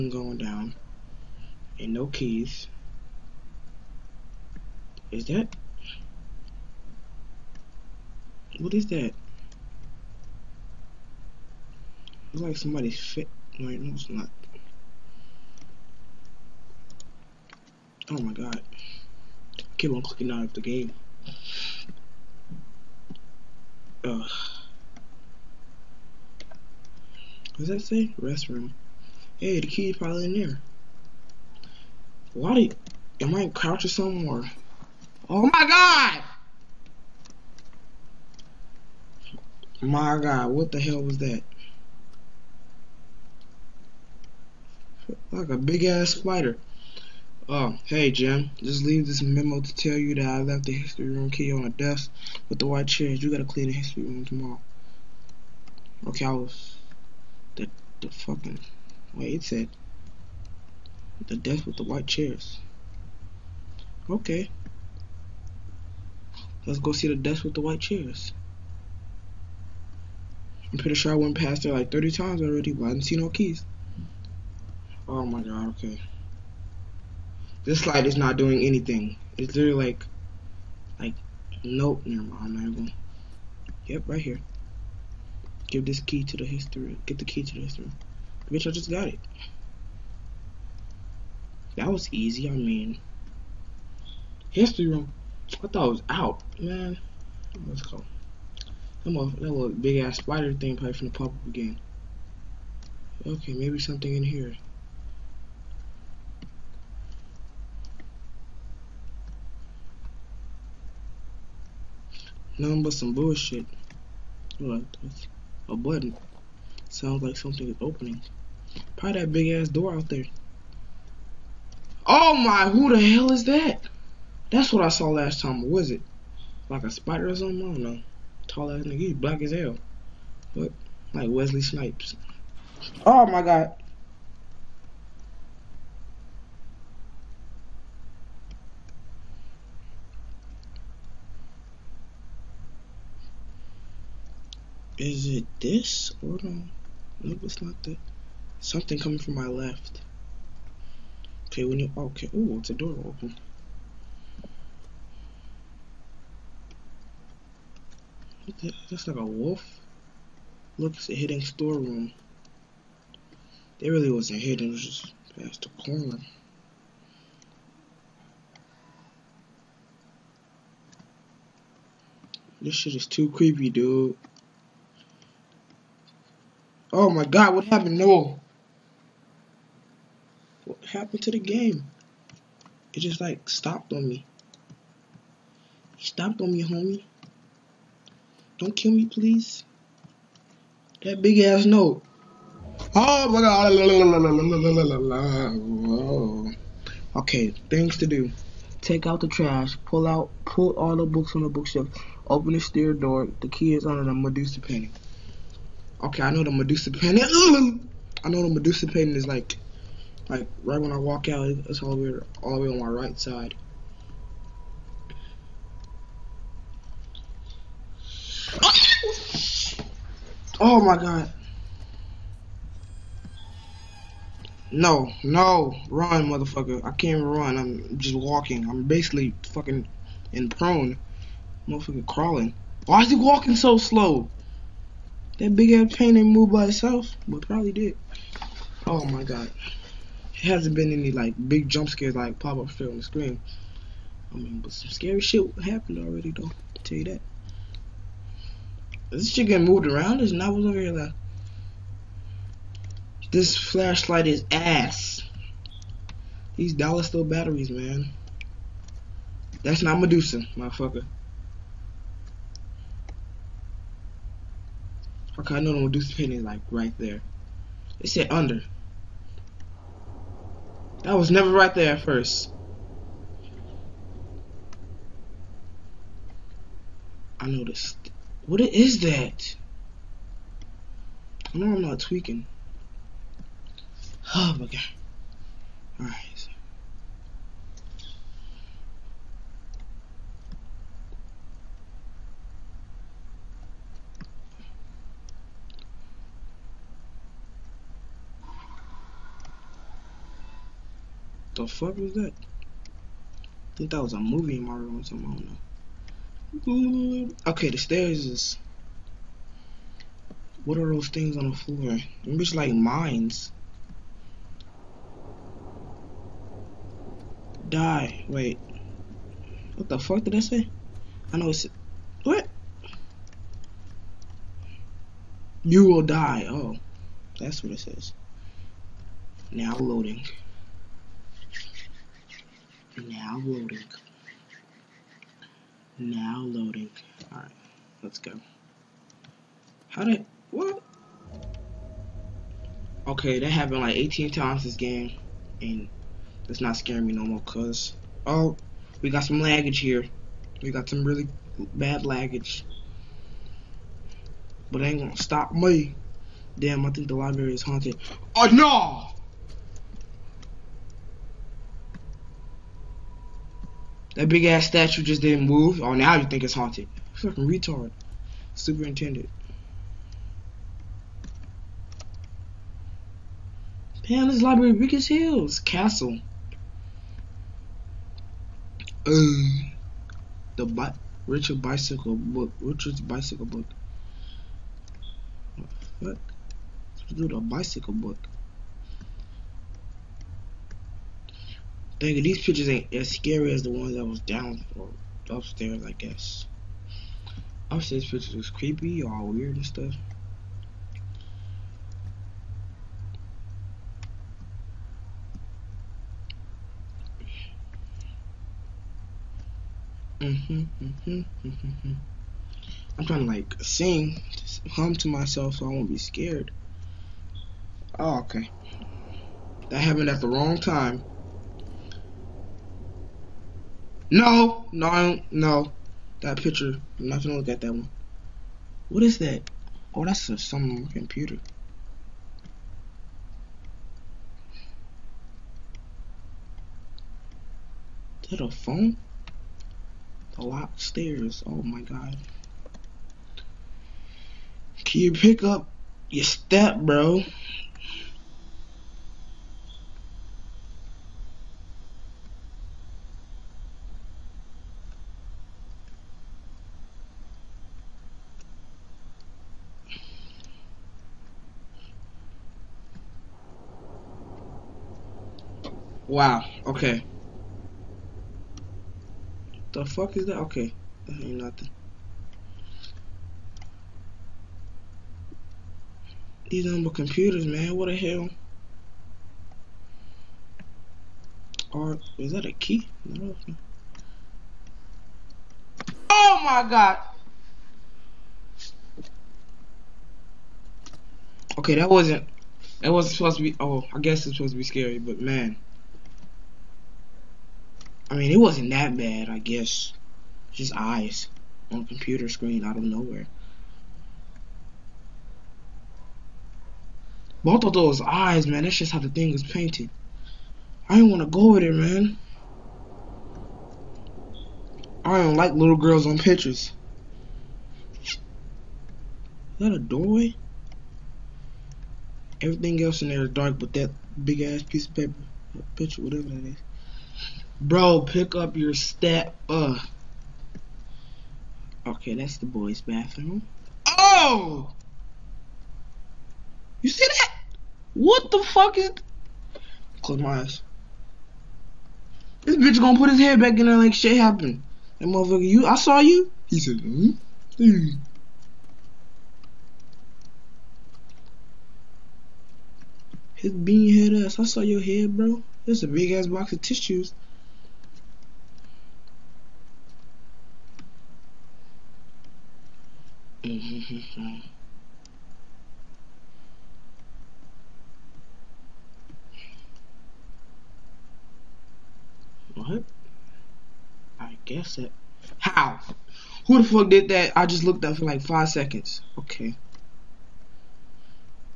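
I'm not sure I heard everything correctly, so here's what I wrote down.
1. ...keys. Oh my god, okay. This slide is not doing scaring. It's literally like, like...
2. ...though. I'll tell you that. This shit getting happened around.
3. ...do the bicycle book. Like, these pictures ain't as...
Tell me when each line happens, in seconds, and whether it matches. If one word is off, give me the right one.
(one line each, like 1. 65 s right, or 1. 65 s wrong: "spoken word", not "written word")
1. 73 s wrong: "anything", not "scaring"
2. 246 s wrong: "moved", not "happened"
3. 387 s right.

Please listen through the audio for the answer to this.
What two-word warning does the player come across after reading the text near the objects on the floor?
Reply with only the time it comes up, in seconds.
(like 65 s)
325 s.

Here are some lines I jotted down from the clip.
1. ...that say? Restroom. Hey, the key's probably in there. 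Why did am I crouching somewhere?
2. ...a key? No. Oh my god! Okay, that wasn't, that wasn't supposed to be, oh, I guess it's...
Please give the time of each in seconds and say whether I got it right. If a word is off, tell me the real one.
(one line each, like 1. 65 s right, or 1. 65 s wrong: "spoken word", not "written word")
1. 27 s right
2. 482 s right.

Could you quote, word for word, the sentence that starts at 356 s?
Damn, I think the library is haunted.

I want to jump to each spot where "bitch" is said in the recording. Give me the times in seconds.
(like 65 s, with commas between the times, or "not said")
88 s, 542 s.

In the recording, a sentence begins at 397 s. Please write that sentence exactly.
Upstairs pictures was creepy, all weird and stuff.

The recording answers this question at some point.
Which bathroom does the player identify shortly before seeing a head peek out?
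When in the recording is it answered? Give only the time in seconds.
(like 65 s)
532 s.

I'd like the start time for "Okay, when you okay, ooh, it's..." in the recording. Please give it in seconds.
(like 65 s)
151 s.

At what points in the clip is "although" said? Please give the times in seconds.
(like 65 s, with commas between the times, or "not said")
not said.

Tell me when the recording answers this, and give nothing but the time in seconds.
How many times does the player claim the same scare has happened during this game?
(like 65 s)
343 s.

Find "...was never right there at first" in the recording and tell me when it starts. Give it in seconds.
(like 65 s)
271 s.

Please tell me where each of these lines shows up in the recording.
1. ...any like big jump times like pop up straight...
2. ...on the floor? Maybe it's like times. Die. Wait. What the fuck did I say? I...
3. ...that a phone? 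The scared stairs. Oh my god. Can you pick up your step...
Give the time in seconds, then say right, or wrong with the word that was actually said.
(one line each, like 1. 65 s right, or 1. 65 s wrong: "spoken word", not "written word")
1. 240 s wrong: "scares", not "times"
2. 311 s wrong: "mines", not "times"
3. 438 s wrong: "locked", not "scared".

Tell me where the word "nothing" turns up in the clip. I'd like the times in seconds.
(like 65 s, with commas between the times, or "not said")
112 s, 471 s.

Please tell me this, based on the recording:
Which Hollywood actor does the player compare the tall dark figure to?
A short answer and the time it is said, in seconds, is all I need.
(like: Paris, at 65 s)
Wesley Snipes, at 131 s.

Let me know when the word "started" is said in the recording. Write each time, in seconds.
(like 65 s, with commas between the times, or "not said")
not said.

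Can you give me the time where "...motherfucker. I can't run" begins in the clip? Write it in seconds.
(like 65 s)
226 s.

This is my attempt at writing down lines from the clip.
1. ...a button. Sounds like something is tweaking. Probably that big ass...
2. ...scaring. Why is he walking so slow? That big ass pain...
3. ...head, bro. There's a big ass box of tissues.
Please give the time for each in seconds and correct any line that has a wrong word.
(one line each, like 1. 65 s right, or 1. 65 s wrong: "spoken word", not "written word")
1. 115 s wrong: "opening", not "tweaking"
2. 232 s wrong: "crawling", not "scaring"
3. 554 s right.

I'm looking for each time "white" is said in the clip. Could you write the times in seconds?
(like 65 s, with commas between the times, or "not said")
52 s, 61 s, 67 s.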